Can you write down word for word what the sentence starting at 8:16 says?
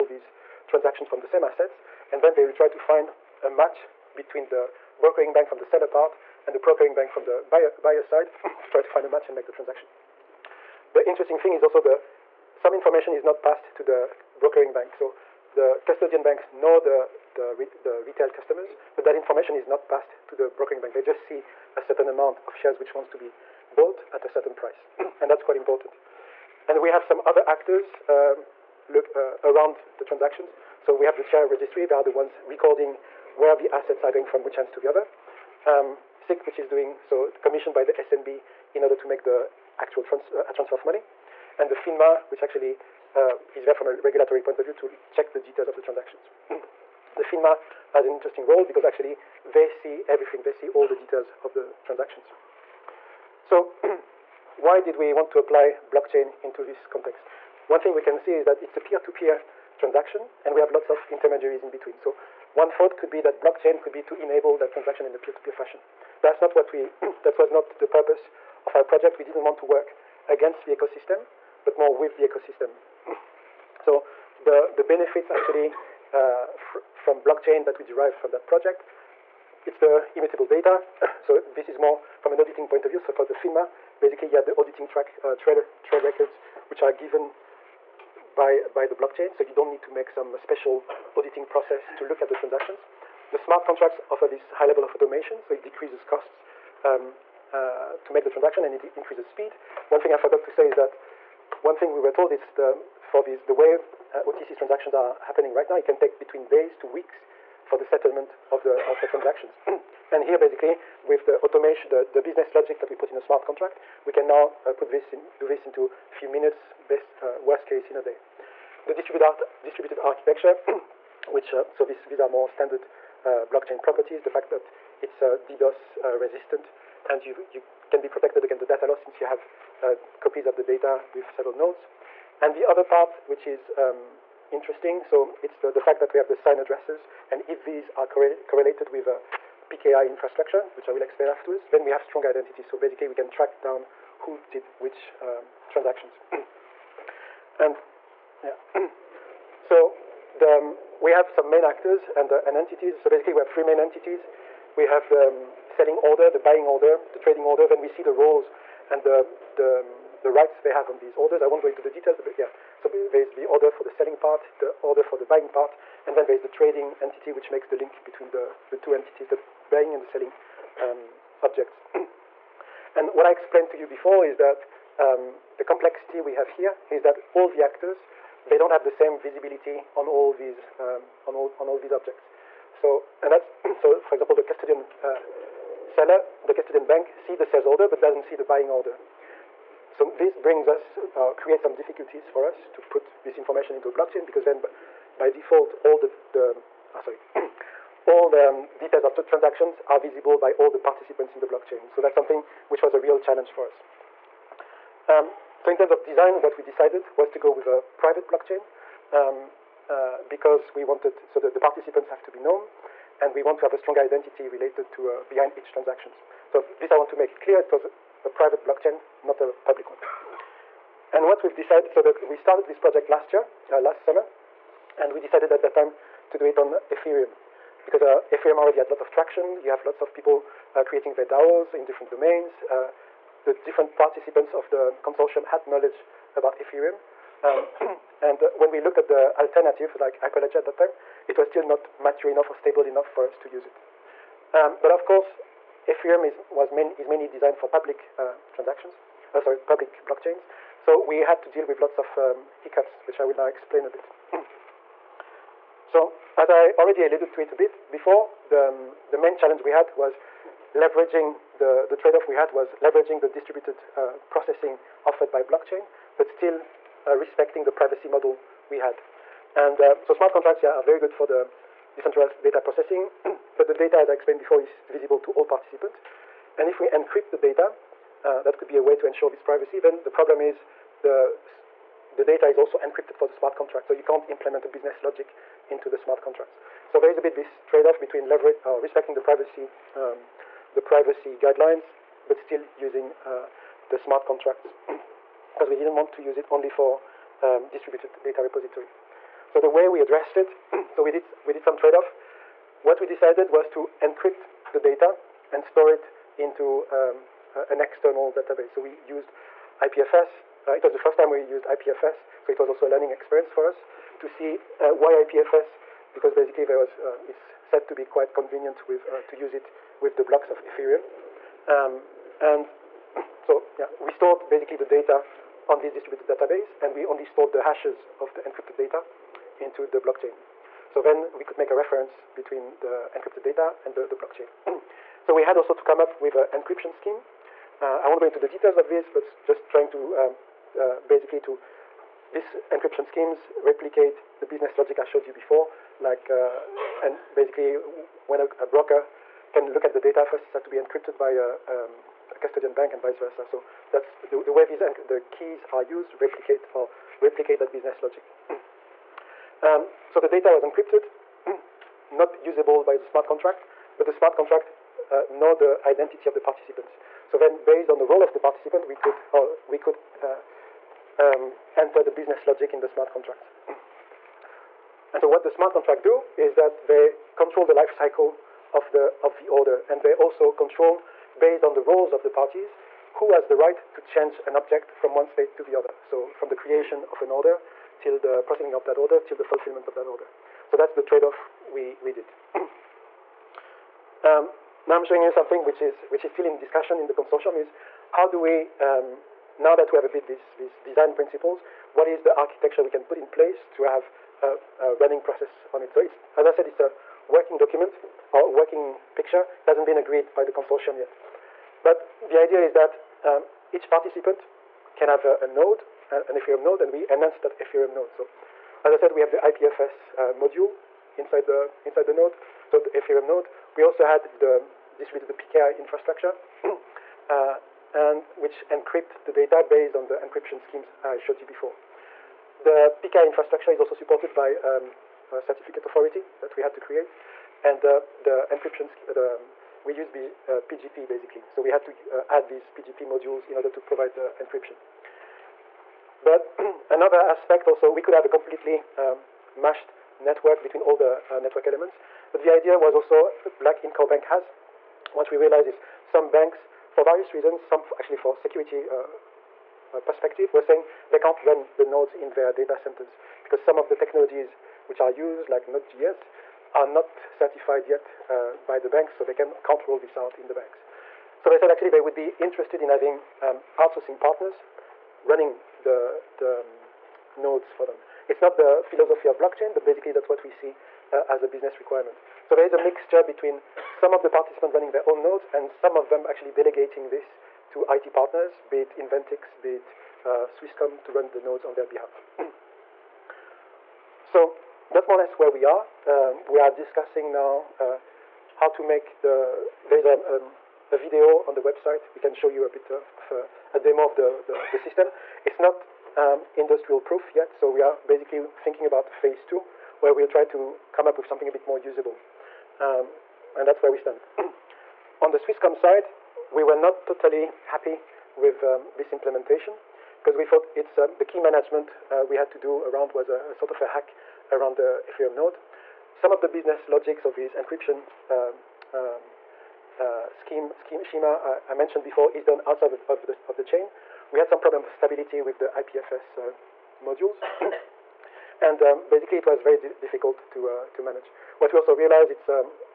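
Um, we are discussing now uh, how to make the there is a, um, a video on the website.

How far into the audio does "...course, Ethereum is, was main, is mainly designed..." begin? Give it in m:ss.
4:05.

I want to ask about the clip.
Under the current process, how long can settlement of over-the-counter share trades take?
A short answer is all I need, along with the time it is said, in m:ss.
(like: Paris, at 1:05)
Days to weeks, at 1:46.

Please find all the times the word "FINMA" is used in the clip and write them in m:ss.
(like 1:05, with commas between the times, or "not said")
0:41, 0:47, 1:23.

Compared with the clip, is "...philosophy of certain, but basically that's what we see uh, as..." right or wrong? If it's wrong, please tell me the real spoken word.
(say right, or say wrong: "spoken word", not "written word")
wrong: "blockchain", not "certain".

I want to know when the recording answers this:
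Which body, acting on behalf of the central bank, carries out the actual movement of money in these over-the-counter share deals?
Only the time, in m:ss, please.
0:36.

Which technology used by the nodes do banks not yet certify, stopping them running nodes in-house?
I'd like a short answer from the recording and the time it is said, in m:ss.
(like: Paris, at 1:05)
Node.js, at 7:45.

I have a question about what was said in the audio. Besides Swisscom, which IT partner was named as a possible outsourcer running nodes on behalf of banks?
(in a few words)
Inventix.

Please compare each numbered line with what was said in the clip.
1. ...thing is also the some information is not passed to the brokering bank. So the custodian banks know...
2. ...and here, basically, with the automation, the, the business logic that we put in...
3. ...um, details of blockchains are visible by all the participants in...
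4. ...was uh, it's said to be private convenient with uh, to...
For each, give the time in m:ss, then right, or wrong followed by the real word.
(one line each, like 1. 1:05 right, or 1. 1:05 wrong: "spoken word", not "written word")
1. 0:11 right
2. 1:50 right
3. 3:18 wrong: "transactions", not "blockchains"
4. 5:16 wrong: "quite", not "private".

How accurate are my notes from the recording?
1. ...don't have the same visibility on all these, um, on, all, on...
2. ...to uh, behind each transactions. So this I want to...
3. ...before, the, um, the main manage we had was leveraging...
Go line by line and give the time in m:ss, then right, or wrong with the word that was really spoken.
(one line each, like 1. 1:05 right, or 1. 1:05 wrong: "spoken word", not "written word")
1. 2:58 right
2. 3:34 right
3. 4:17 wrong: "challenge", not "manage".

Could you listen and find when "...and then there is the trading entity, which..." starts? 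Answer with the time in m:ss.
2:46.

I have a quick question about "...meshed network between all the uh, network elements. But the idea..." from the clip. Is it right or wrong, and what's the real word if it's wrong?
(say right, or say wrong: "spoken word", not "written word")
right.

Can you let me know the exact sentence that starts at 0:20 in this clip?
They just see a certain amount of shares which wants to be bought at a certain price.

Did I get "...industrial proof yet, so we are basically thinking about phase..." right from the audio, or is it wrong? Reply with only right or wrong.
right.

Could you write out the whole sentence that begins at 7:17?
And uh, the encryption, uh, the, um, we use B, PGP basically.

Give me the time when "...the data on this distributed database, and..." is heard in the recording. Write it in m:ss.
5:24.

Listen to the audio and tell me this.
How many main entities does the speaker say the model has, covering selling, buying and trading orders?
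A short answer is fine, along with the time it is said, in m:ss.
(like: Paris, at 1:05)
3, at 2:33.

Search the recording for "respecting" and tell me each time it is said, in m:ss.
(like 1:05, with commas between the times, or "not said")
4:27, 4:48.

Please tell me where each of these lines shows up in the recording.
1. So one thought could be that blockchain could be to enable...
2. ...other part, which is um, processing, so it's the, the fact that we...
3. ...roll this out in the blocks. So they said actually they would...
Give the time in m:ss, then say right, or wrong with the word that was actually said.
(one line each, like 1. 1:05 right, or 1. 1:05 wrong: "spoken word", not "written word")
1. 1:01 right
2. 2:12 wrong: "interesting", not "processing"
3. 7:49 wrong: "banks", not "blocks".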